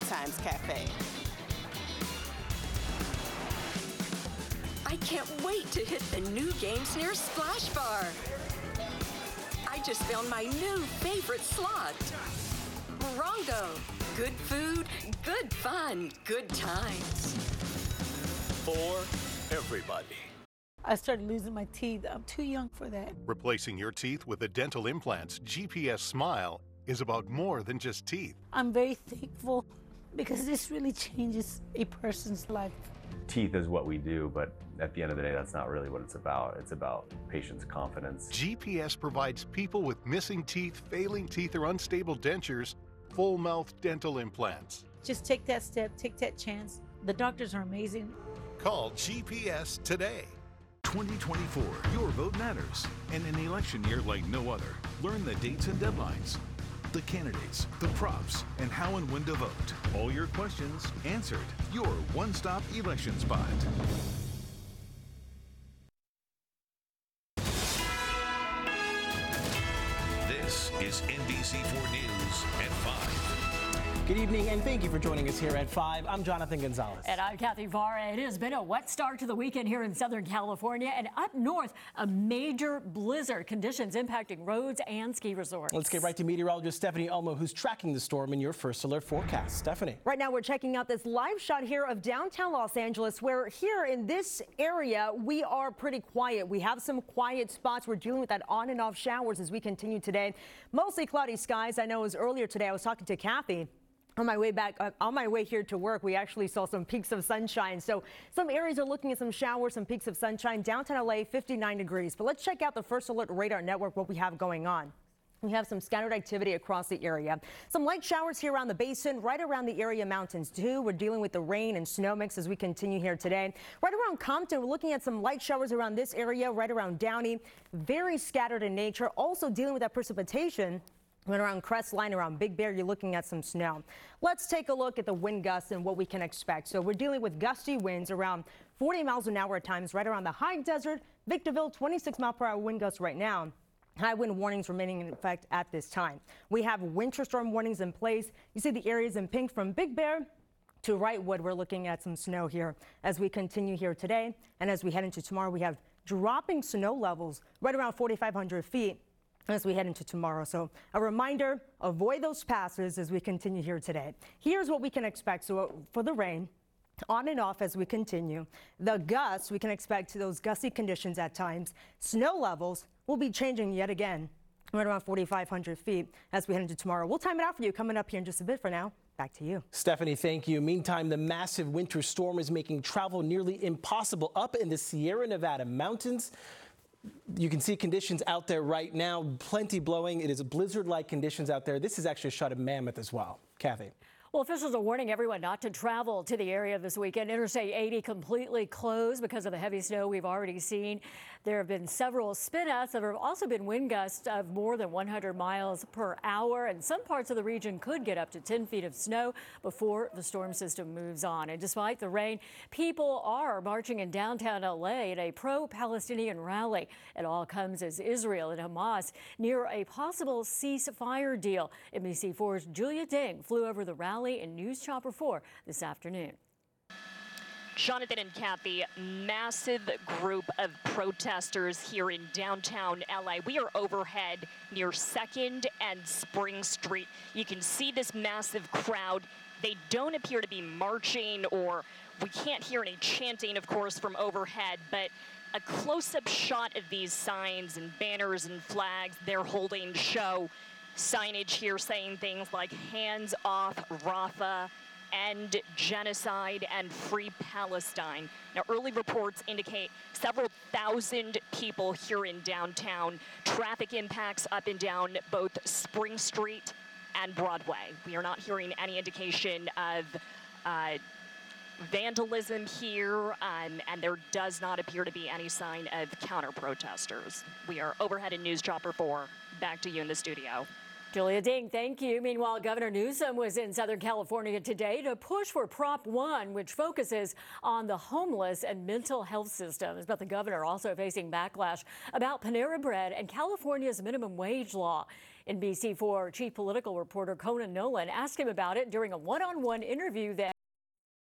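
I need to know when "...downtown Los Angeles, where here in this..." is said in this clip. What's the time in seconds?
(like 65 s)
92 s.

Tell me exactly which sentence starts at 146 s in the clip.
We have winter storm warnings in place.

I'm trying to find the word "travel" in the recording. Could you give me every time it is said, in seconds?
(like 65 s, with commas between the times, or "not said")
182 s, 195 s.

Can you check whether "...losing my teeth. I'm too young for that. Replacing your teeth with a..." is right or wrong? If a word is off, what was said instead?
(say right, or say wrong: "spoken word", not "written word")
right.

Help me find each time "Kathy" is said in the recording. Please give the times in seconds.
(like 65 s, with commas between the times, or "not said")
77 s, 103 s, 193 s, 228 s.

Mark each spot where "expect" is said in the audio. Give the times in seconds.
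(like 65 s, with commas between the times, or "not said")
136 s, 165 s, 169 s.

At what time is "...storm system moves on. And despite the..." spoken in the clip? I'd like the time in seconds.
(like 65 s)
210 s.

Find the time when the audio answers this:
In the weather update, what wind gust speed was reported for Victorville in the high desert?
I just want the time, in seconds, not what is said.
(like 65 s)
141 s.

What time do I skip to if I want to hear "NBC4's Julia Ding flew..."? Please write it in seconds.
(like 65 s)
221 s.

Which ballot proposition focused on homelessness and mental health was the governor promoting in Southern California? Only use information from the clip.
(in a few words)
Prop 1.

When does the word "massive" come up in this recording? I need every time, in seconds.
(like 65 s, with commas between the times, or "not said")
181 s, 228 s, 238 s.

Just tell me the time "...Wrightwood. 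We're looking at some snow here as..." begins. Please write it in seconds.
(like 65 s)
150 s.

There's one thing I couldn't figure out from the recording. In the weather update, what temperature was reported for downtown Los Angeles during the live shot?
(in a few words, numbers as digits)
59 degrees.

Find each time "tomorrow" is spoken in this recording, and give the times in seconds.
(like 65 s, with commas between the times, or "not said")
155 s, 160 s, 176 s.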